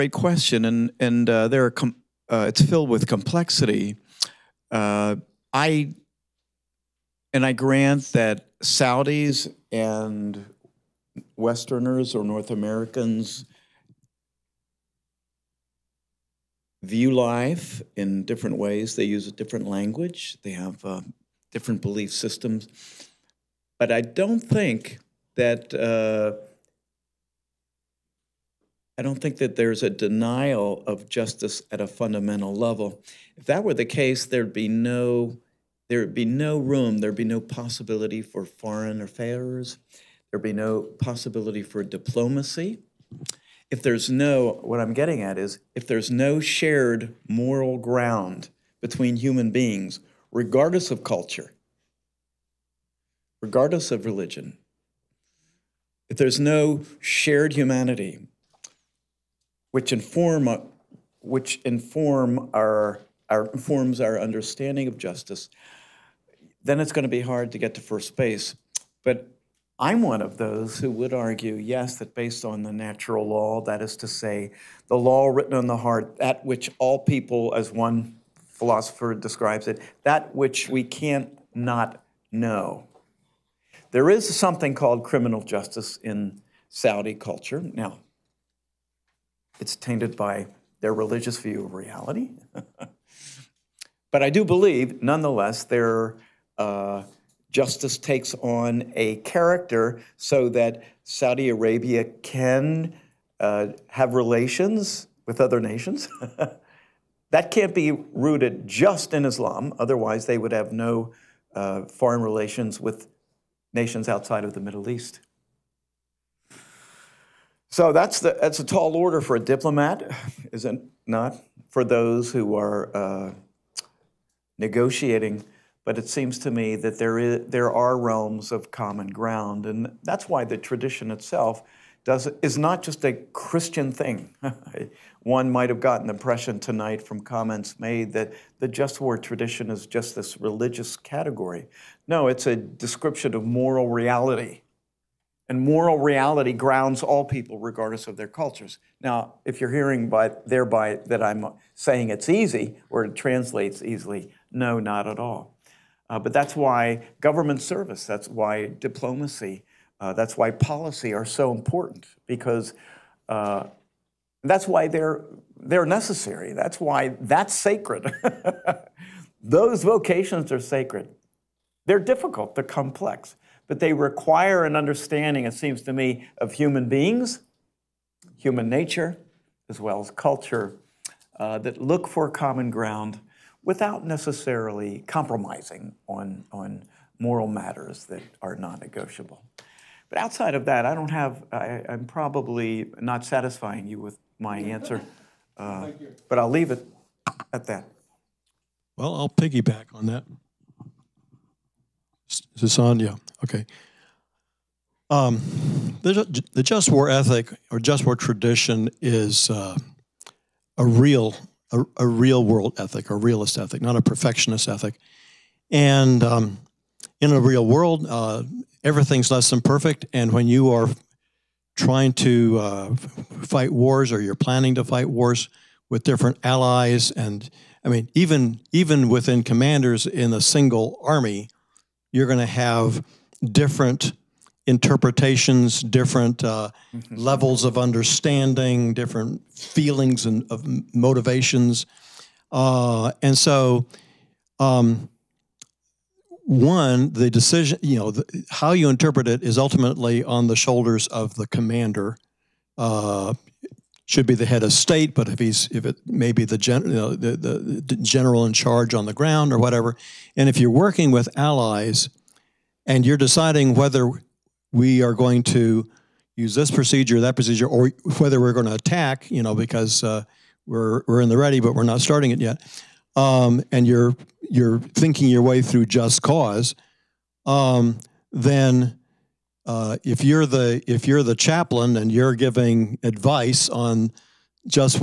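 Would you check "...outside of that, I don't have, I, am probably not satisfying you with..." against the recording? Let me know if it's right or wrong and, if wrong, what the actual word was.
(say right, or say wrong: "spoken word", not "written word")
right.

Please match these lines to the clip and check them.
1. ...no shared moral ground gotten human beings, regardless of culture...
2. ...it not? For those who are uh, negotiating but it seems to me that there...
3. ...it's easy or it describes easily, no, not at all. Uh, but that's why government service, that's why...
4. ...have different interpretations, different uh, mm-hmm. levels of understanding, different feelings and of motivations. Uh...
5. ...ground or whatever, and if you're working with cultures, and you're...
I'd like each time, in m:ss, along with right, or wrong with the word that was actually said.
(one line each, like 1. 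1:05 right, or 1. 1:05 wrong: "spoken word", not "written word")
1. 0:46 wrong: "between", not "gotten"
2. 2:00 right
3. 2:32 wrong: "translates", not "describes"
4. 3:52 right
5. 4:19 wrong: "allies", not "cultures".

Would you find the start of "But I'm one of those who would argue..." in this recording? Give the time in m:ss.
1:09.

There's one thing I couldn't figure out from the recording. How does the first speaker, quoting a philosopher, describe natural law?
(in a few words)
that which we can't not know.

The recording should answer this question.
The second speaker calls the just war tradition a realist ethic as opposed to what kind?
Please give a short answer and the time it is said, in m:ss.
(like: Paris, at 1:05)
a perfectionist ethic, at 3:34.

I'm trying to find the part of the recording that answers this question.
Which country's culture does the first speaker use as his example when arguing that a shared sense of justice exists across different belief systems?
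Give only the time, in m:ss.
1:26.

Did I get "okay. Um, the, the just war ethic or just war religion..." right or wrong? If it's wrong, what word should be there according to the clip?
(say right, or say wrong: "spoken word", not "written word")
wrong: "tradition", not "religion".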